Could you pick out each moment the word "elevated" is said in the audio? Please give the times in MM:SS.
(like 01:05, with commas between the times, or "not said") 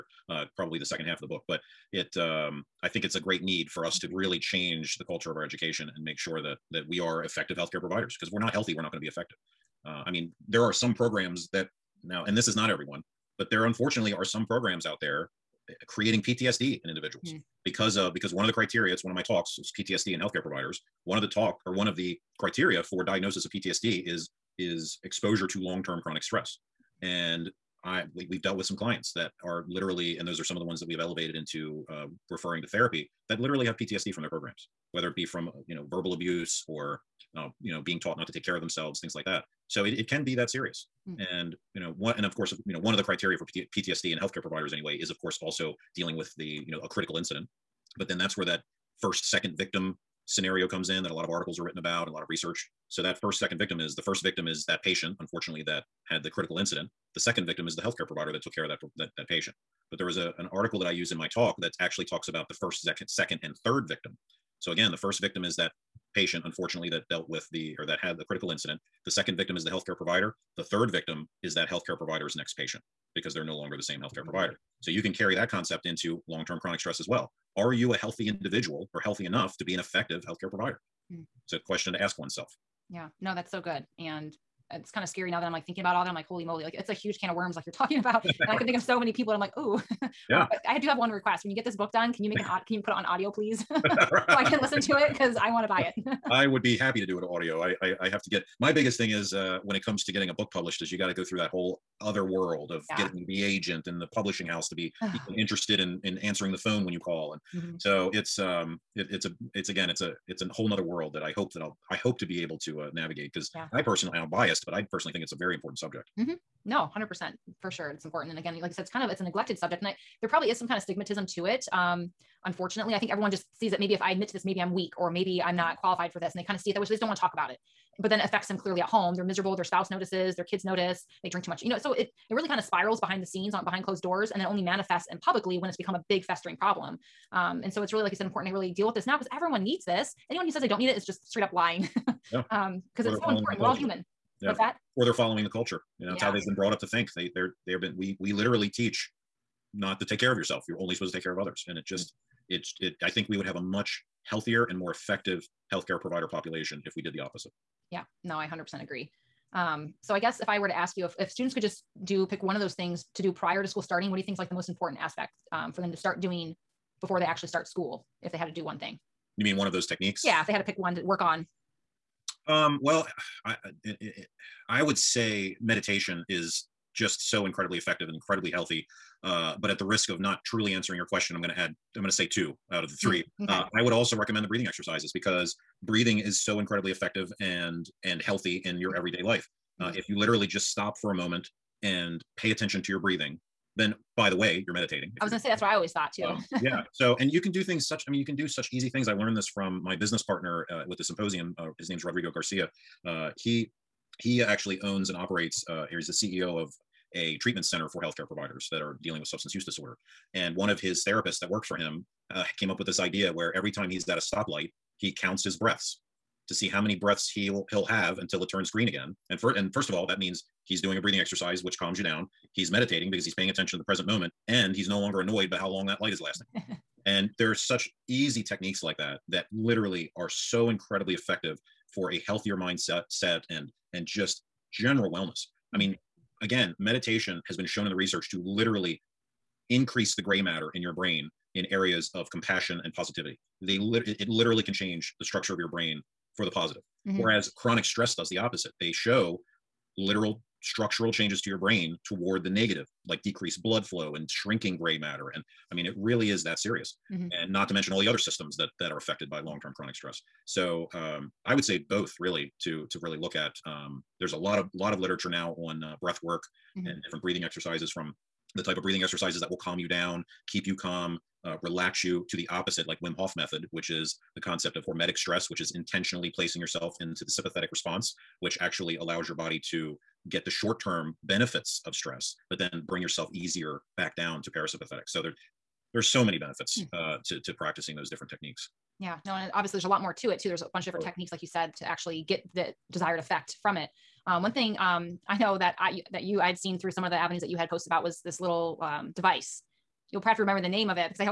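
00:31.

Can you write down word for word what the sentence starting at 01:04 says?
So again, the first victim is that patient, unfortunately, that dealt with the or that had the critical incident.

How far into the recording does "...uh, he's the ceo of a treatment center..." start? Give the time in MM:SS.
03:25.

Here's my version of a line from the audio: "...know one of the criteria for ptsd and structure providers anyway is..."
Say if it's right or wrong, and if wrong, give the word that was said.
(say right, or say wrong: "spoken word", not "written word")
wrong: "healthcare", not "structure".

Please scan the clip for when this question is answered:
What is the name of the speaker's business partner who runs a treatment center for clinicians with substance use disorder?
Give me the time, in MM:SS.
03:22.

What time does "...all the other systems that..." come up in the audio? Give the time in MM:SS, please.
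04:17.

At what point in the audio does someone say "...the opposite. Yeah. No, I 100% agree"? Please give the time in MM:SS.
02:37.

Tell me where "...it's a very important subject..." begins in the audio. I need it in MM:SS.
01:55.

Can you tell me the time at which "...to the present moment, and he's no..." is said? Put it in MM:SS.
03:43.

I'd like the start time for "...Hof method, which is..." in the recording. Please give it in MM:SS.
04:33.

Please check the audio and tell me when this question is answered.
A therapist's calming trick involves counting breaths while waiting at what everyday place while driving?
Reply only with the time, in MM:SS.
03:34.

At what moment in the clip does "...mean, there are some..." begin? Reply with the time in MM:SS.
00:10.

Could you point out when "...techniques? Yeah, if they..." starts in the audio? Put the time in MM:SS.
02:49.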